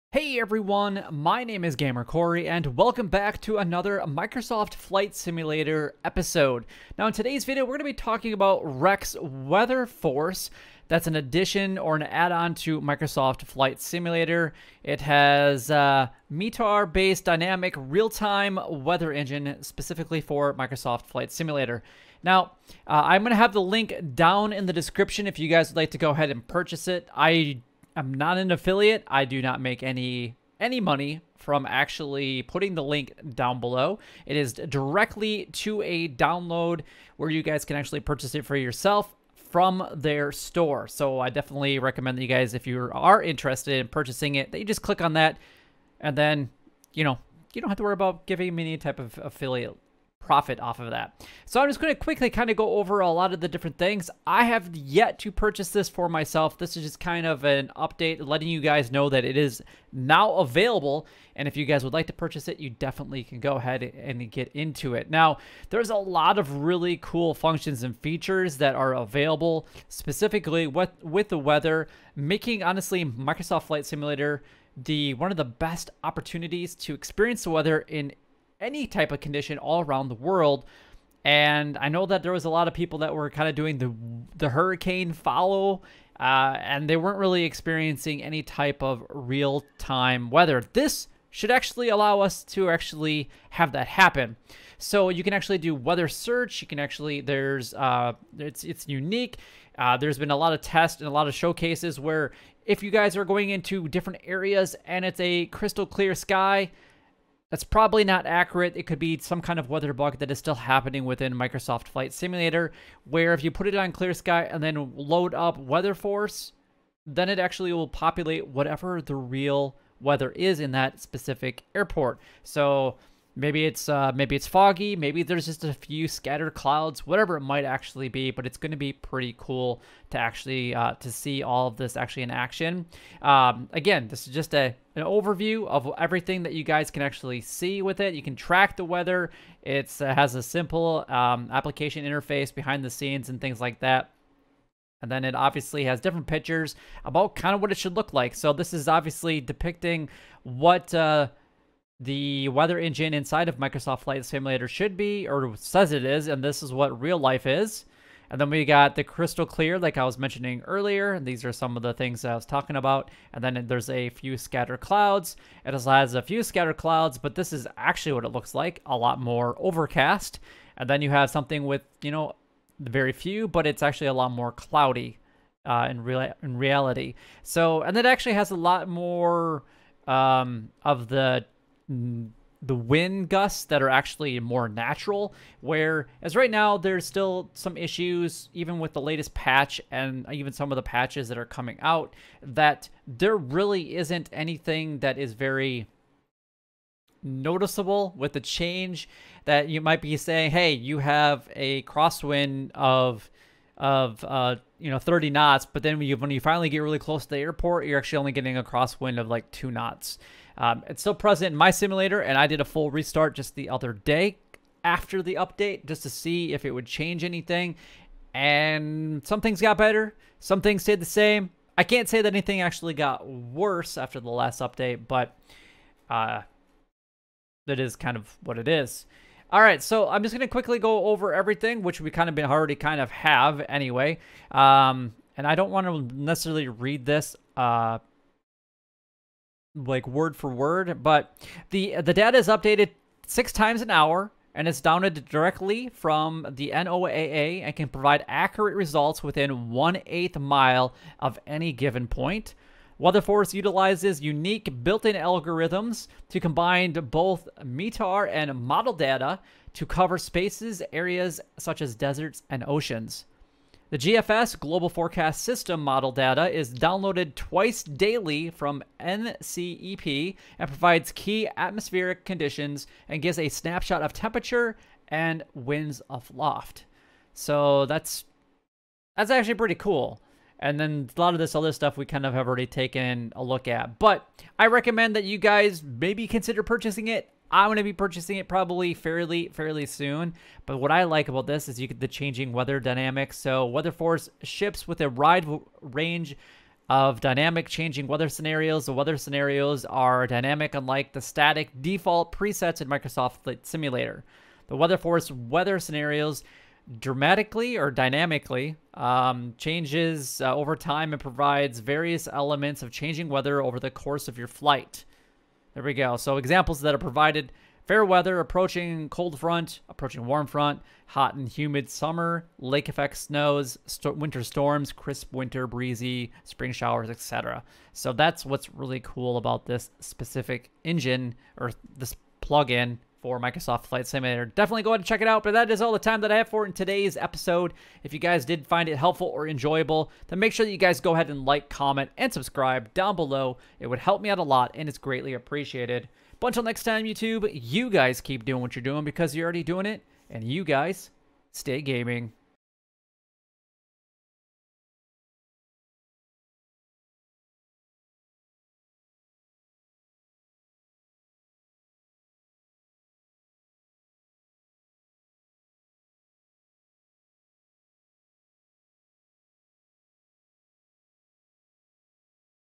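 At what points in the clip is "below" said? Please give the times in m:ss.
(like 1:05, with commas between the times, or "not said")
0:33, 5:43.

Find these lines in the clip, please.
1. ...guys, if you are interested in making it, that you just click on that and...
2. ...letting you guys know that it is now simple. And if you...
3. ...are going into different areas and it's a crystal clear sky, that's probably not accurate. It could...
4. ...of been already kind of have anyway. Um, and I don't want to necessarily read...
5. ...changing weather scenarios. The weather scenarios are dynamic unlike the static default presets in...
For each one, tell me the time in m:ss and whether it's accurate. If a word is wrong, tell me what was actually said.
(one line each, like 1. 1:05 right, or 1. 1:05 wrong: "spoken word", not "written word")
1. 0:42 wrong: "purchasing", not "making"
2. 0:58 wrong: "available", not "simple"
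3. 1:43 right
4. 3:52 right
5. 4:57 right.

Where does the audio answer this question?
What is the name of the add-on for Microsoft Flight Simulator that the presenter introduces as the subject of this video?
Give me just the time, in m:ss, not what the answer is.
0:08.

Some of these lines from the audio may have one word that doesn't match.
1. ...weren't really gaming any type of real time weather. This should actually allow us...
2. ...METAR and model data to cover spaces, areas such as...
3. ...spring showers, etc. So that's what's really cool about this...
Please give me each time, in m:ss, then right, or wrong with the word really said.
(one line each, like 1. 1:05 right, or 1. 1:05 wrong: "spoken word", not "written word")
1. 1:26 wrong: "experiencing", not "gaming"
2. 4:17 right
3. 5:26 right.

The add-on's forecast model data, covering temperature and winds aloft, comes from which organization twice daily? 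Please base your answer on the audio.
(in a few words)
NCEP.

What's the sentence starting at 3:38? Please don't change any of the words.
And some things got better, some things stayed the same.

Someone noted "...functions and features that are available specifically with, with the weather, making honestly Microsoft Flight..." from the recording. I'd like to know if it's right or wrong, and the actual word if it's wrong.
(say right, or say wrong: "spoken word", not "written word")
right.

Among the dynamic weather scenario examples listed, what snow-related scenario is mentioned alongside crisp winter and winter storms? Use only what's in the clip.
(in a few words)
Lake effect snows.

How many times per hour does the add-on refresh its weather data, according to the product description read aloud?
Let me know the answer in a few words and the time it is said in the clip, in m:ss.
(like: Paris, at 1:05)
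6, at 4:03.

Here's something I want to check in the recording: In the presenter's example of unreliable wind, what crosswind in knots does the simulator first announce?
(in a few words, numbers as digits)
30.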